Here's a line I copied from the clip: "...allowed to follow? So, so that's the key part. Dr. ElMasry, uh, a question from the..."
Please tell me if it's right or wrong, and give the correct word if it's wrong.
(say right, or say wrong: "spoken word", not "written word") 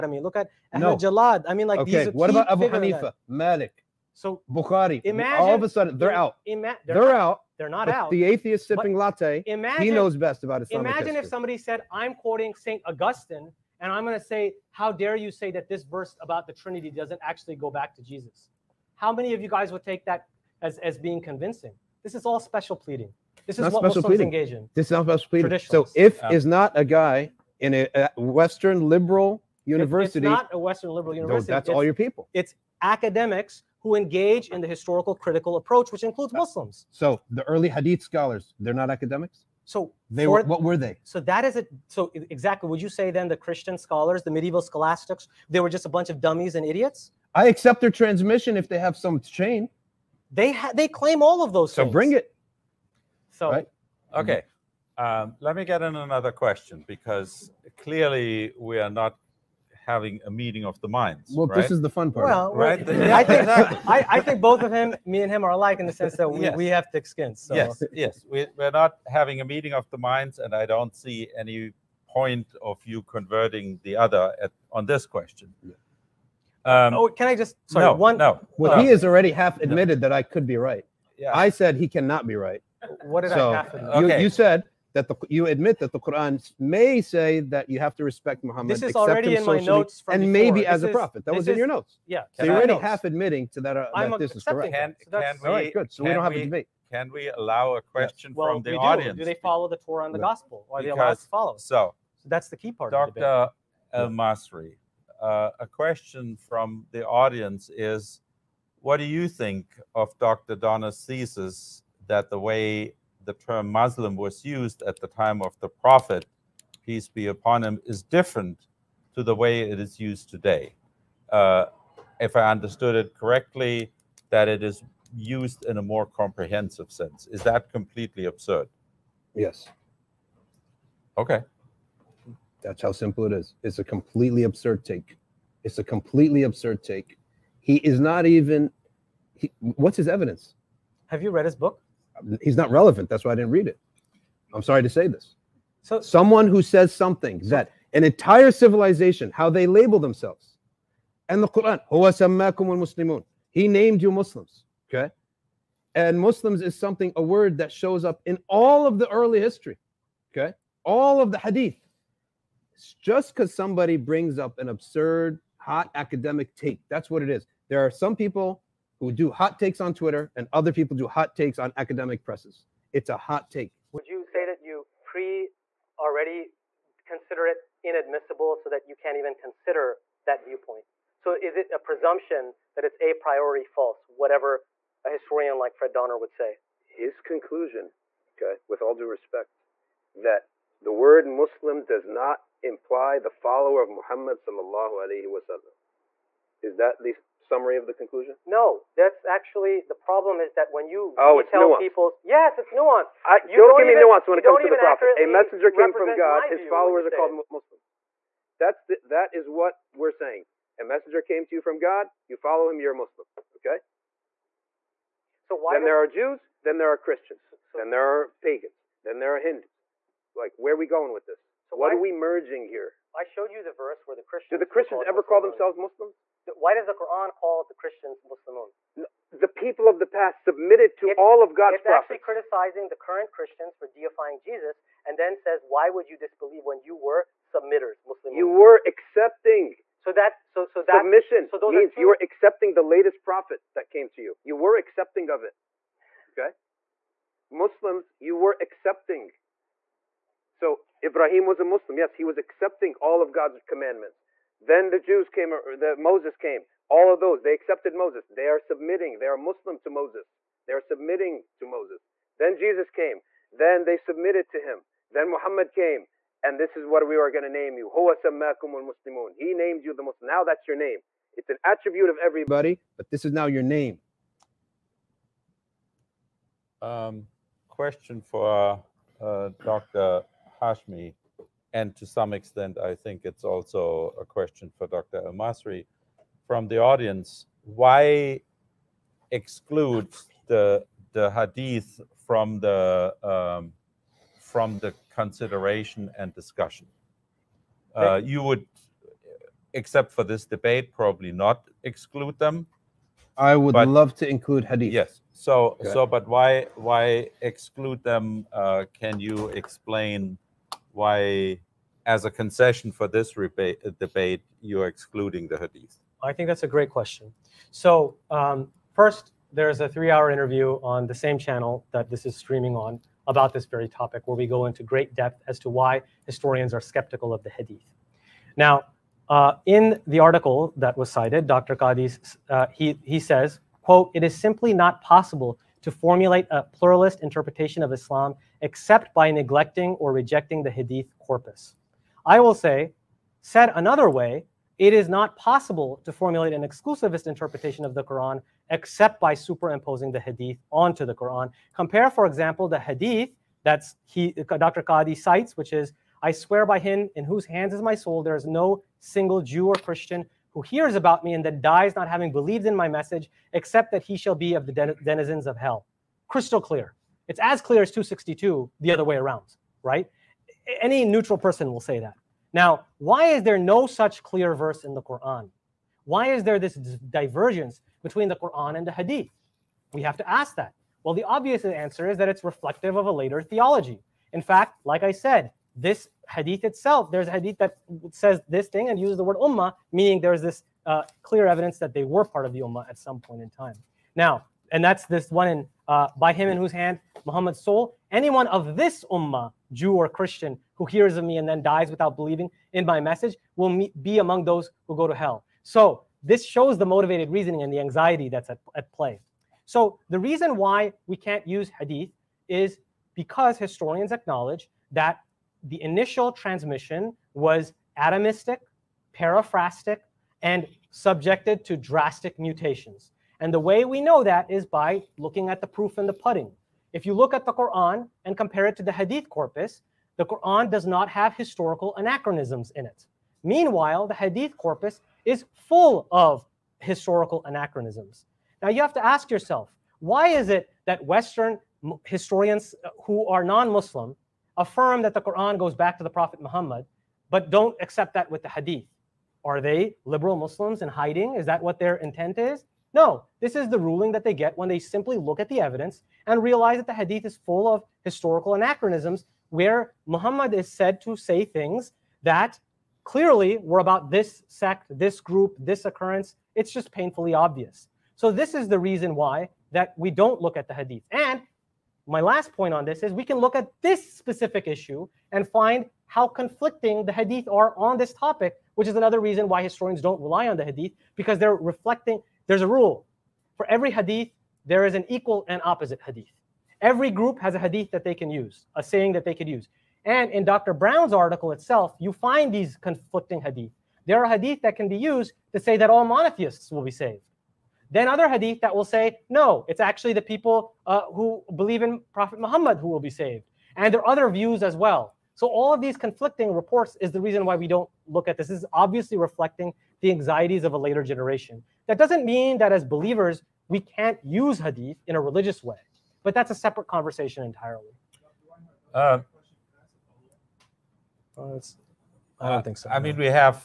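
right.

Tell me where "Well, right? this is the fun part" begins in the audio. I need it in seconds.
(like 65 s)
61 s.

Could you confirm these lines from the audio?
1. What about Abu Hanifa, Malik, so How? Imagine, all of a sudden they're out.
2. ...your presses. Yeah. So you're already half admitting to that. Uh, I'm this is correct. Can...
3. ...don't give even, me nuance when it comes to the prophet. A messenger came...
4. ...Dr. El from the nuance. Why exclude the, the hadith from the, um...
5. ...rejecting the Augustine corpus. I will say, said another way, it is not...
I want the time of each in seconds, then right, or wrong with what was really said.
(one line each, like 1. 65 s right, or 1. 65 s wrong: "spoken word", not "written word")
1. 2 s wrong: "Bukhari", not "How"
2. 91 s wrong: "notes", not "presses"
3. 203 s right
4. 284 s wrong: "audience", not "nuance"
5. 340 s wrong: "Hadith", not "Augustine".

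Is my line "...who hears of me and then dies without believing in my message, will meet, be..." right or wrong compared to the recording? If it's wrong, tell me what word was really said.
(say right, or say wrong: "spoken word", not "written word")
right.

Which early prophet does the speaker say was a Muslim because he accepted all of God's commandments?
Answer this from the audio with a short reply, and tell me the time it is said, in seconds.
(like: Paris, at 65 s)
Ibrahim, at 251 s.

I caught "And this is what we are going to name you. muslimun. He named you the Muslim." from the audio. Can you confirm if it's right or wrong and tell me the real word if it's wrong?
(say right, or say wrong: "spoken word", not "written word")
right.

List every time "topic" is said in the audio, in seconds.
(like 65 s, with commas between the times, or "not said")
323 s, 478 s.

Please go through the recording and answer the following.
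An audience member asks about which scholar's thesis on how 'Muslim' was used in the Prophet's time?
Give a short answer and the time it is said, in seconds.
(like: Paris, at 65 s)
Dr. Donner, at 110 s.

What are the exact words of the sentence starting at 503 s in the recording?
And there are other views as well.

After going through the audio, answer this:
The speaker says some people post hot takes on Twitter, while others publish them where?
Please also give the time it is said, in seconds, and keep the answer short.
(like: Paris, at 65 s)
academic presses, at 171 s.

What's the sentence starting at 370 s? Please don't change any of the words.
Any neutral person will say that.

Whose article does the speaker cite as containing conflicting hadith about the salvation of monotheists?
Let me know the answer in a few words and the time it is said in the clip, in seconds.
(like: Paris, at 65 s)
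Dr. Brown, at 490 s.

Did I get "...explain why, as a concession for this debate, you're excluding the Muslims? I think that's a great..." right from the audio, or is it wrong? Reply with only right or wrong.
wrong.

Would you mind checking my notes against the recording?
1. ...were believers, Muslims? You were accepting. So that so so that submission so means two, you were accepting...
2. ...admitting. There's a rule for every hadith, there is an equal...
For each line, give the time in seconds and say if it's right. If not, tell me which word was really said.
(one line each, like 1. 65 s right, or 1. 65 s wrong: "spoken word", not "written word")
1. 236 s wrong: "submitters", not "believers"
2. 481 s wrong: "reflecting", not "admitting".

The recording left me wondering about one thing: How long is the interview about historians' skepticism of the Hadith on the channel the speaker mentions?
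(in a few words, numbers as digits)
three hour.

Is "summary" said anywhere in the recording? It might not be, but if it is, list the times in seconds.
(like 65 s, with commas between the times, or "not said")
197 s.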